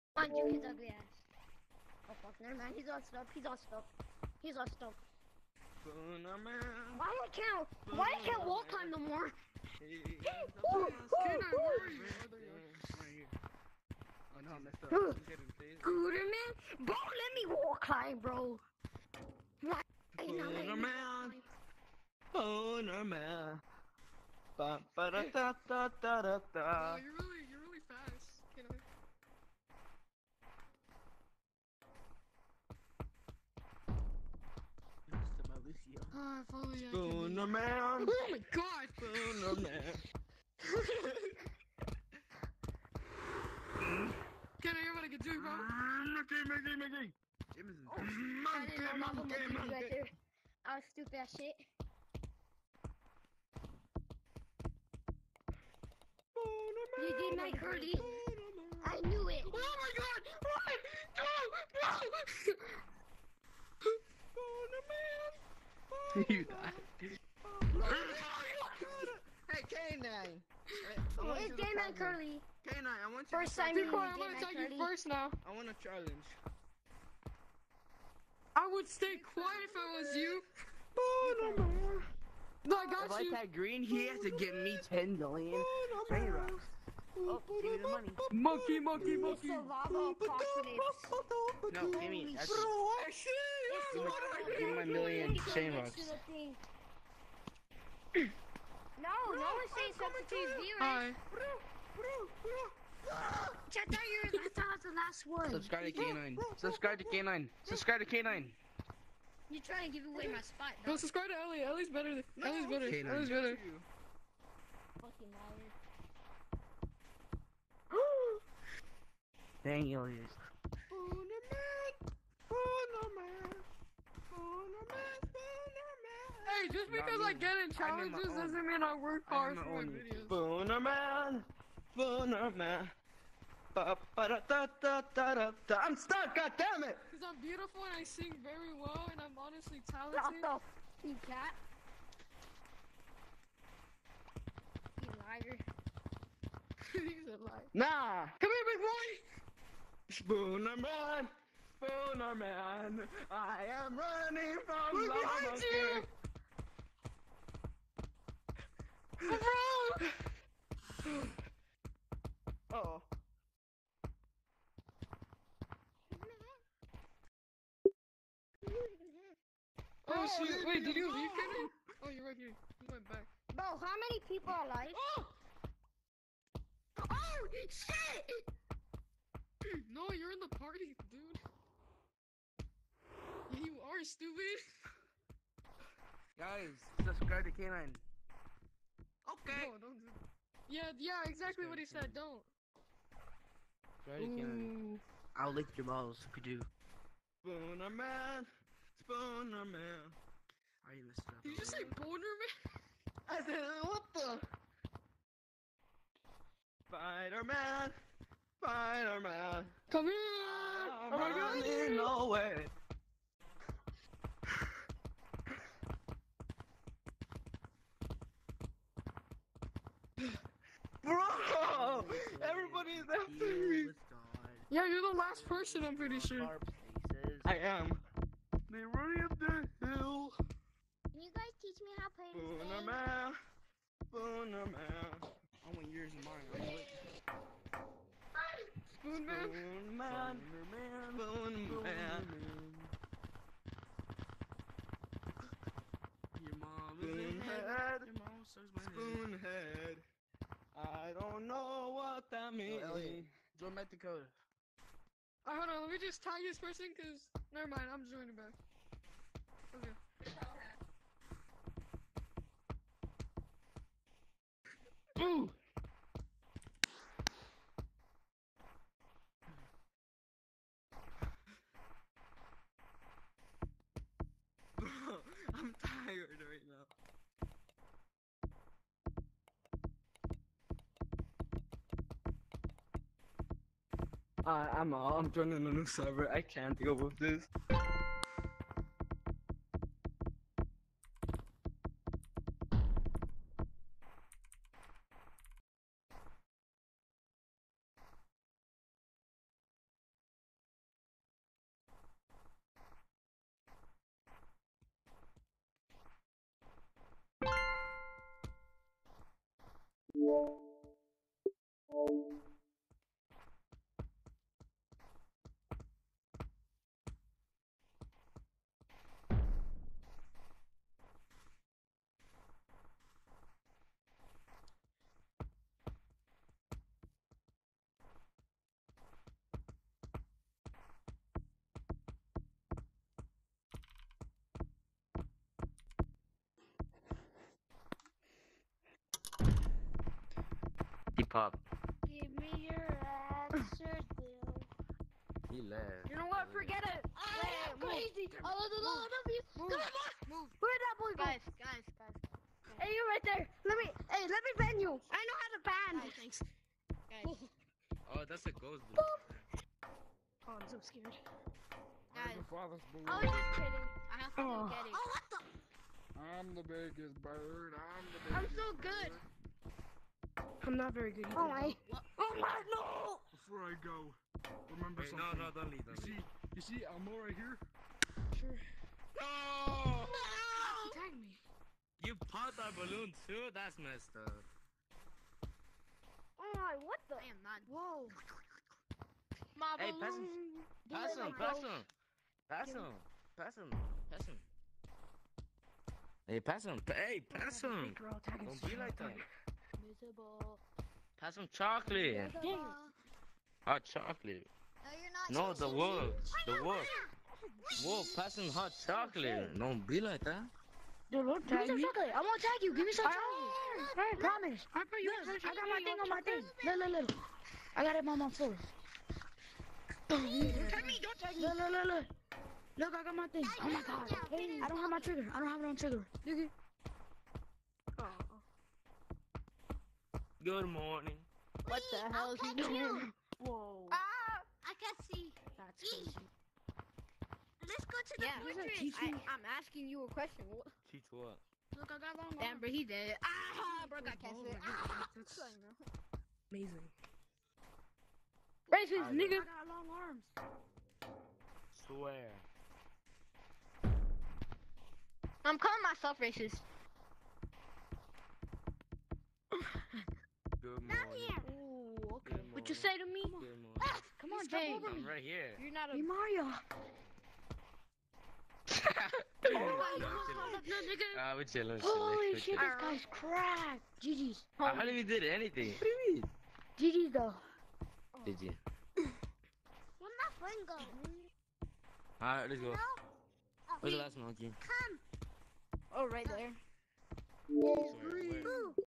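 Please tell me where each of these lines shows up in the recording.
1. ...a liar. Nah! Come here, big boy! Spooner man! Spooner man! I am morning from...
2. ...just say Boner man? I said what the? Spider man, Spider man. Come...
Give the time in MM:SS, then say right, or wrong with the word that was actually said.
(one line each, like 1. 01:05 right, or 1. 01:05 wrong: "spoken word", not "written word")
1. 02:27 wrong: "running", not "morning"
2. 03:21 right.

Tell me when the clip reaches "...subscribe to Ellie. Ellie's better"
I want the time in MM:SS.
01:50.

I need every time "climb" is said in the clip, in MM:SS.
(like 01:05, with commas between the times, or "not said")
00:08, 00:17.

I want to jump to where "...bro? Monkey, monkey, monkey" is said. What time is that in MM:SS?
00:45.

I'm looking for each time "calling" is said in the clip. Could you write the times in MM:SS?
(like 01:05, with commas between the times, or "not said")
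07:35.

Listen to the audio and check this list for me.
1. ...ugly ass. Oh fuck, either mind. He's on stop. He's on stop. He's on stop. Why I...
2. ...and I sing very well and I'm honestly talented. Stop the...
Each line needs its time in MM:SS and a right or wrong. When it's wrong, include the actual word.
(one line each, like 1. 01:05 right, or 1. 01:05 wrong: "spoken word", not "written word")
1. 00:00 wrong: "never", not "either"
2. 02:17 right.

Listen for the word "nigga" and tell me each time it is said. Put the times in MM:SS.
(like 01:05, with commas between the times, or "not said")
07:29.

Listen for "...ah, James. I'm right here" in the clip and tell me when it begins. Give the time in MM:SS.
07:44.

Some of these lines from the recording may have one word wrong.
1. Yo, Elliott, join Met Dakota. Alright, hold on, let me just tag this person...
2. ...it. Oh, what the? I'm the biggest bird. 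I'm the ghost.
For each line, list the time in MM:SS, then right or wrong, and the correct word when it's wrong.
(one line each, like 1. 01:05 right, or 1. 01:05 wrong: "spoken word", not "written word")
1. 04:12 right
2. 06:04 wrong: "biggest", not "ghost".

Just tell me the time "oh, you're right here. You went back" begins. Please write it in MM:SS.
02:52.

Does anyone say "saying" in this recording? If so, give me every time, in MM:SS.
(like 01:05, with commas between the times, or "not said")
01:39.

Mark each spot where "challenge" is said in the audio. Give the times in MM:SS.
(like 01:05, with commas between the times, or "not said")
01:15, 02:07.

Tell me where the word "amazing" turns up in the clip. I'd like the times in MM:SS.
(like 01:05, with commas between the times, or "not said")
07:26.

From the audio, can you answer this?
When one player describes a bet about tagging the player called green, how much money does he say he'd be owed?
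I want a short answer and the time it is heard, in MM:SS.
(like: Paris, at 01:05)
10 million, at 01:24.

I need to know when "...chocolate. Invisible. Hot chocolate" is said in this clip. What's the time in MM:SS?
06:41.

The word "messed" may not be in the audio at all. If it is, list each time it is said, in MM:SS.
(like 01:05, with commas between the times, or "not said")
03:21, 06:23.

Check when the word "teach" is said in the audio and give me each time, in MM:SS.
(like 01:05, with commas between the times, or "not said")
03:51, 07:20.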